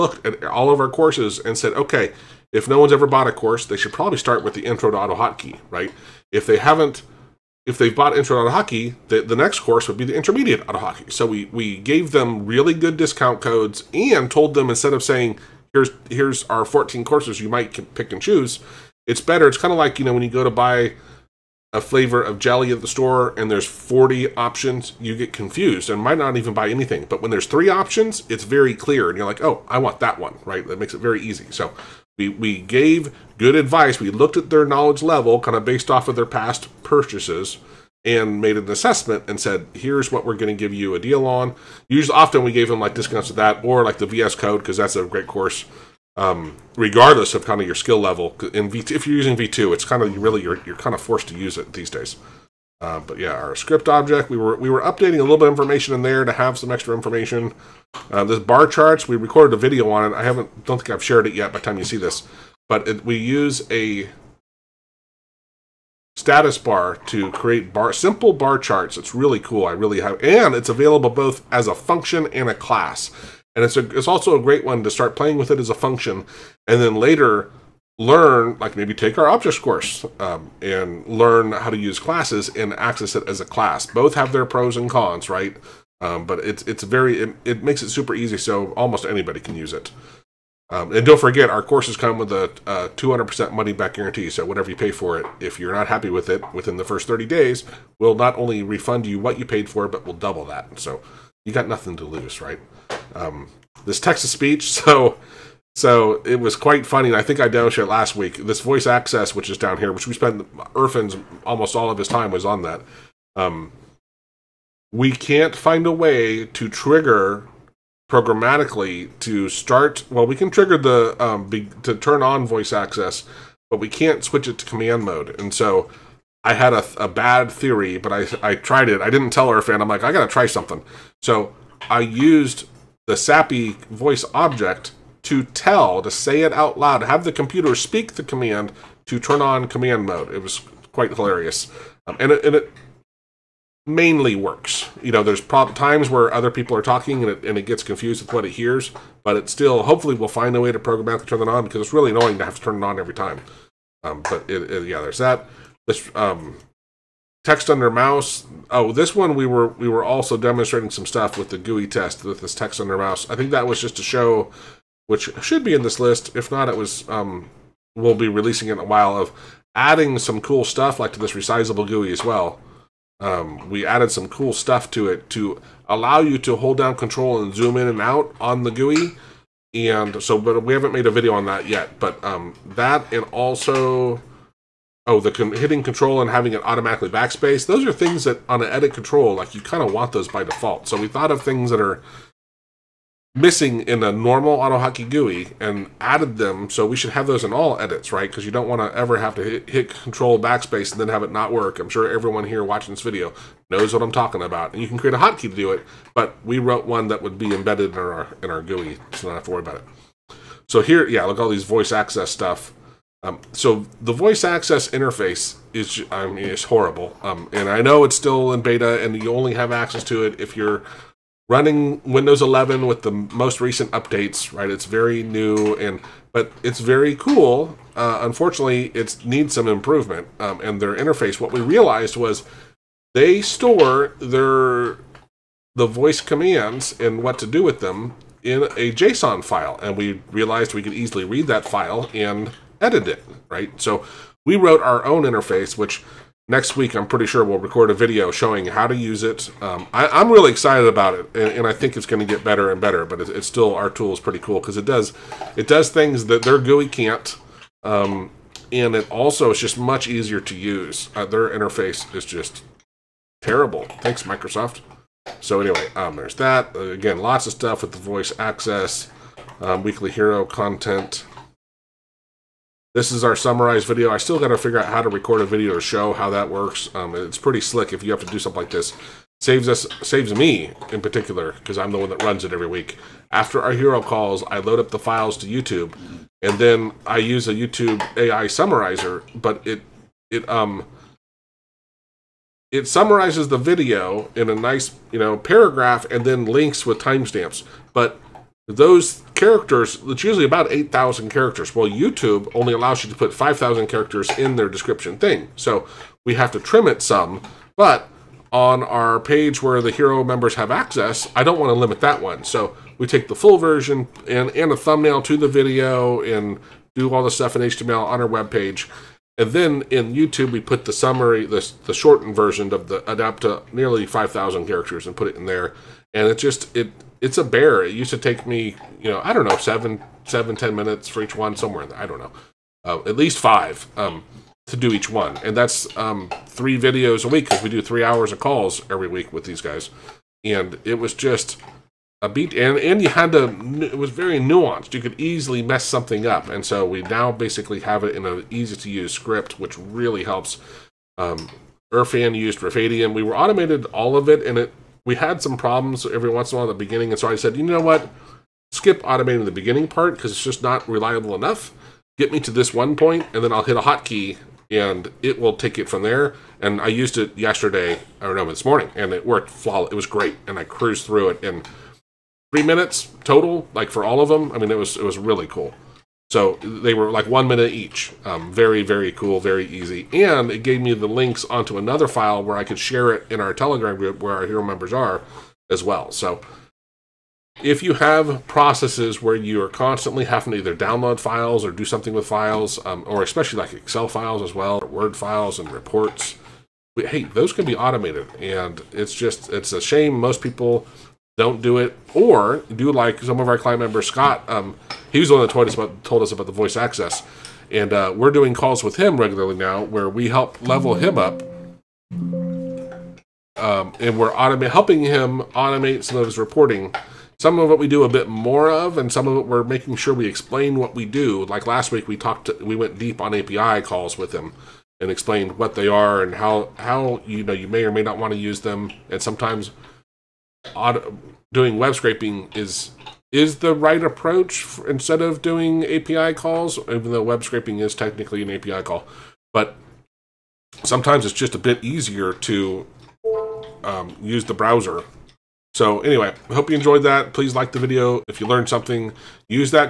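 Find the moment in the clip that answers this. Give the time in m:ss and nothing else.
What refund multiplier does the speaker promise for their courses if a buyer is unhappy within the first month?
1:32.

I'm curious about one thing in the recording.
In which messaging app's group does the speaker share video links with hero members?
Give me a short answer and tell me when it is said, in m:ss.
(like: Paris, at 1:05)
Telegram, at 6:23.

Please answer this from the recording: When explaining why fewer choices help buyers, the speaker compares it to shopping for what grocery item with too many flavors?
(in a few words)
jelly.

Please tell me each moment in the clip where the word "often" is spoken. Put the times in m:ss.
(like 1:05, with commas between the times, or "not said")
0:42.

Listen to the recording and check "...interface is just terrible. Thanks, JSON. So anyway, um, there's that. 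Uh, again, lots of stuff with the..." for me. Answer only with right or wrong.
wrong.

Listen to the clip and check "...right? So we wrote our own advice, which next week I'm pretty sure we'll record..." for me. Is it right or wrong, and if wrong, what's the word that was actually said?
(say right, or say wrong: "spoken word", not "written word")
wrong: "interface", not "advice".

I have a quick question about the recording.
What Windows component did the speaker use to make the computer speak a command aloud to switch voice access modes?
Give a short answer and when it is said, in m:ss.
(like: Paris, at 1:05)
SAPI voice object, at 2:13.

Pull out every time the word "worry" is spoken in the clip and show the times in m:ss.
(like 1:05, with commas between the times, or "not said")
3:29.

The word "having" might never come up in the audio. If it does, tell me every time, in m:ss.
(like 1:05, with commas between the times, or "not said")
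3:06, 6:30.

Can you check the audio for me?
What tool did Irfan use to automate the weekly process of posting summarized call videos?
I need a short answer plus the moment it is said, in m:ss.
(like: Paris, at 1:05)
Rufaydium, at 5:52.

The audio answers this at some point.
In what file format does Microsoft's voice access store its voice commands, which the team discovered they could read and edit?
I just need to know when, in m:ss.
3:58.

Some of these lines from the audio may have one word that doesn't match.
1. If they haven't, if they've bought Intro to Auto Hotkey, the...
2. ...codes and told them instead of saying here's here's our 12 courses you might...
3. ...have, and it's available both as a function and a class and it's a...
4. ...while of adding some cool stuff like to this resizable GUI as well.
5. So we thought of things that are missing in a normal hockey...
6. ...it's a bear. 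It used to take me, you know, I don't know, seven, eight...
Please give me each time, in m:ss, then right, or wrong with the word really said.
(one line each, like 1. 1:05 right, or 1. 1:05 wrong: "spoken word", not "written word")
1. 0:06 right
2. 0:13 wrong: "14", not "12"
3. 1:09 right
4. 2:48 right
5. 3:10 right
6. 5:27 wrong: "seven", not "eight".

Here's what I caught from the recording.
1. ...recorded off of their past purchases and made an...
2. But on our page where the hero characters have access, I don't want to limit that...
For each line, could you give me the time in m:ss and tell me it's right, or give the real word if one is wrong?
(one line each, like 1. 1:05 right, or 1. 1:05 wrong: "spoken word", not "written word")
1. 0:35 wrong: "based", not "recorded"
2. 5:07 wrong: "members", not "characters".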